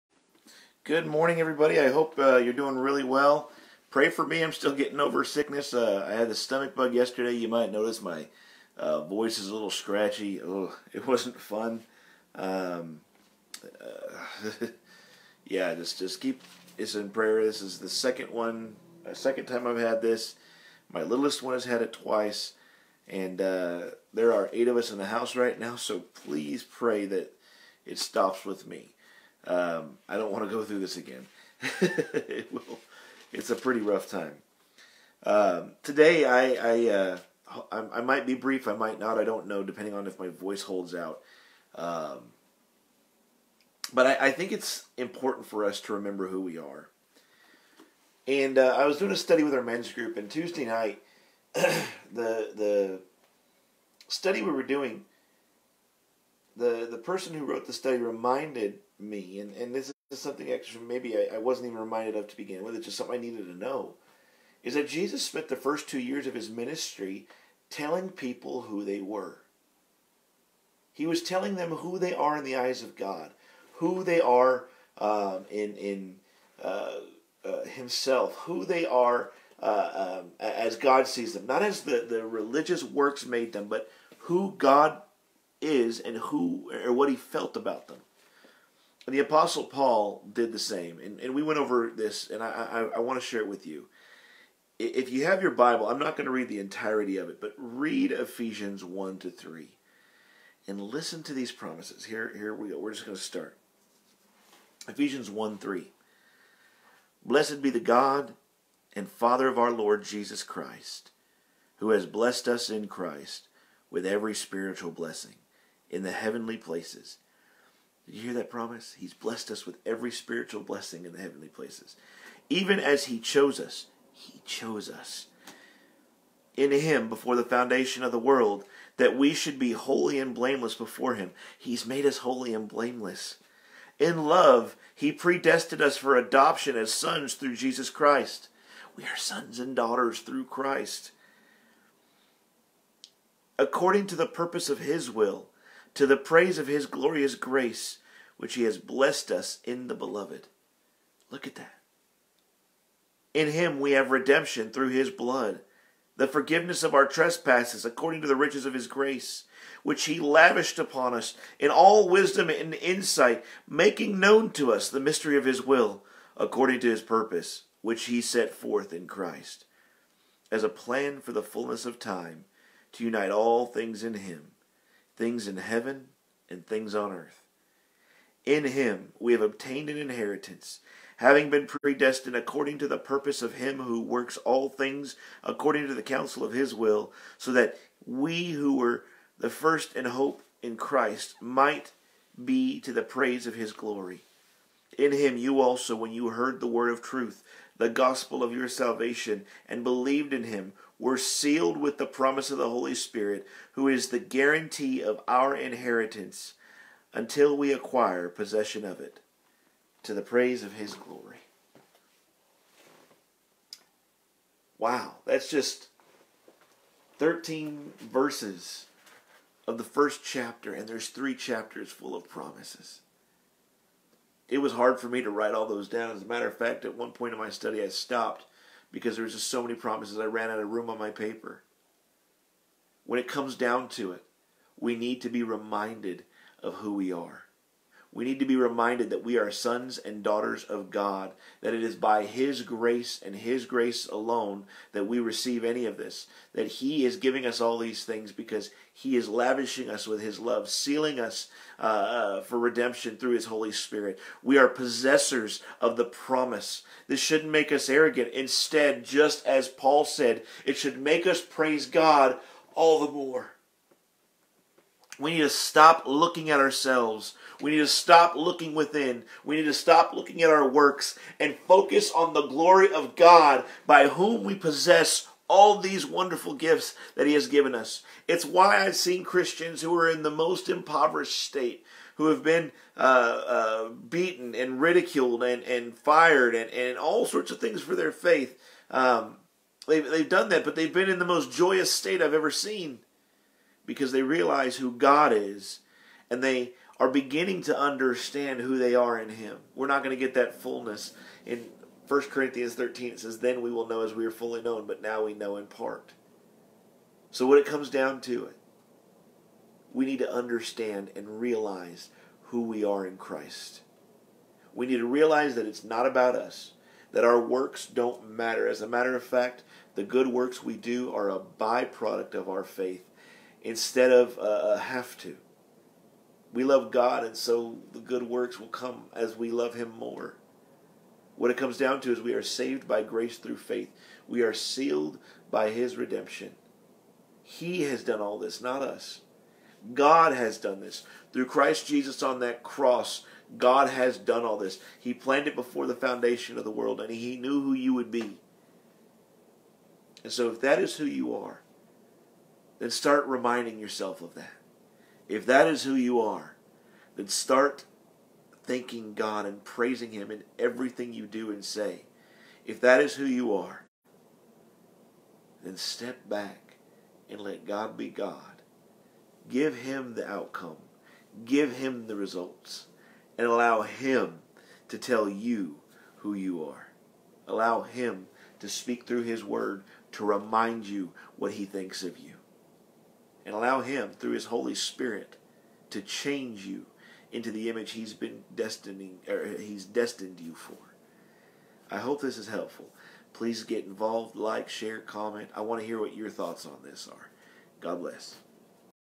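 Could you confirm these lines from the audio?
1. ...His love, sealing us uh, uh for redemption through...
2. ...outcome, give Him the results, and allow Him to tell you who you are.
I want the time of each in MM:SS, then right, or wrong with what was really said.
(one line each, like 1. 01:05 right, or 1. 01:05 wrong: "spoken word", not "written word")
1. 04:10 right
2. 06:10 right.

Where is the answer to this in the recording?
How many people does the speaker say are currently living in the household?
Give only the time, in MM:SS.
00:24.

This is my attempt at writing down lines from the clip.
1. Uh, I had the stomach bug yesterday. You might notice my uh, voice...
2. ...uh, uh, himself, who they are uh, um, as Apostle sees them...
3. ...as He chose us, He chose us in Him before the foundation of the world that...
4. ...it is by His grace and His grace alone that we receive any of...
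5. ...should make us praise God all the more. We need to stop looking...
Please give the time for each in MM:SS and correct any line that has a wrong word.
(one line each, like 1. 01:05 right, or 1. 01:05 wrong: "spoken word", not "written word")
1. 00:05 right
2. 01:16 wrong: "God", not "Apostle"
3. 02:02 right
4. 04:01 right
5. 04:20 right.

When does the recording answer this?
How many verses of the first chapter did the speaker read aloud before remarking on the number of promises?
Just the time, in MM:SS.
03:37.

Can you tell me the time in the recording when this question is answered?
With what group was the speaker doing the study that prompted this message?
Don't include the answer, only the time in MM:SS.
00:49.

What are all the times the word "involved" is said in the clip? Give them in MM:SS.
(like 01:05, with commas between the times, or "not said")
06:33.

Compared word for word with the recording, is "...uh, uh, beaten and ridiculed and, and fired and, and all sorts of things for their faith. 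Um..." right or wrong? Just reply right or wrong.
right.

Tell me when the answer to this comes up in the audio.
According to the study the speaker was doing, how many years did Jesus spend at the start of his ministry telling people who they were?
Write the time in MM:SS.
01:05.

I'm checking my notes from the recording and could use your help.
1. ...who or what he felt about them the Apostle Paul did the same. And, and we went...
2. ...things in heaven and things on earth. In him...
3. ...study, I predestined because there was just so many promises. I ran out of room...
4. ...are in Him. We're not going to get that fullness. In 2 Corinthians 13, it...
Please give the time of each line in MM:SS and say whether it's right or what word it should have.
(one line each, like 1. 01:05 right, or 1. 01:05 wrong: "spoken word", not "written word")
1. 01:26 right
2. 02:55 right
3. 03:47 wrong: "stopped", not "predestined"
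4. 04:58 wrong: "1", not "2".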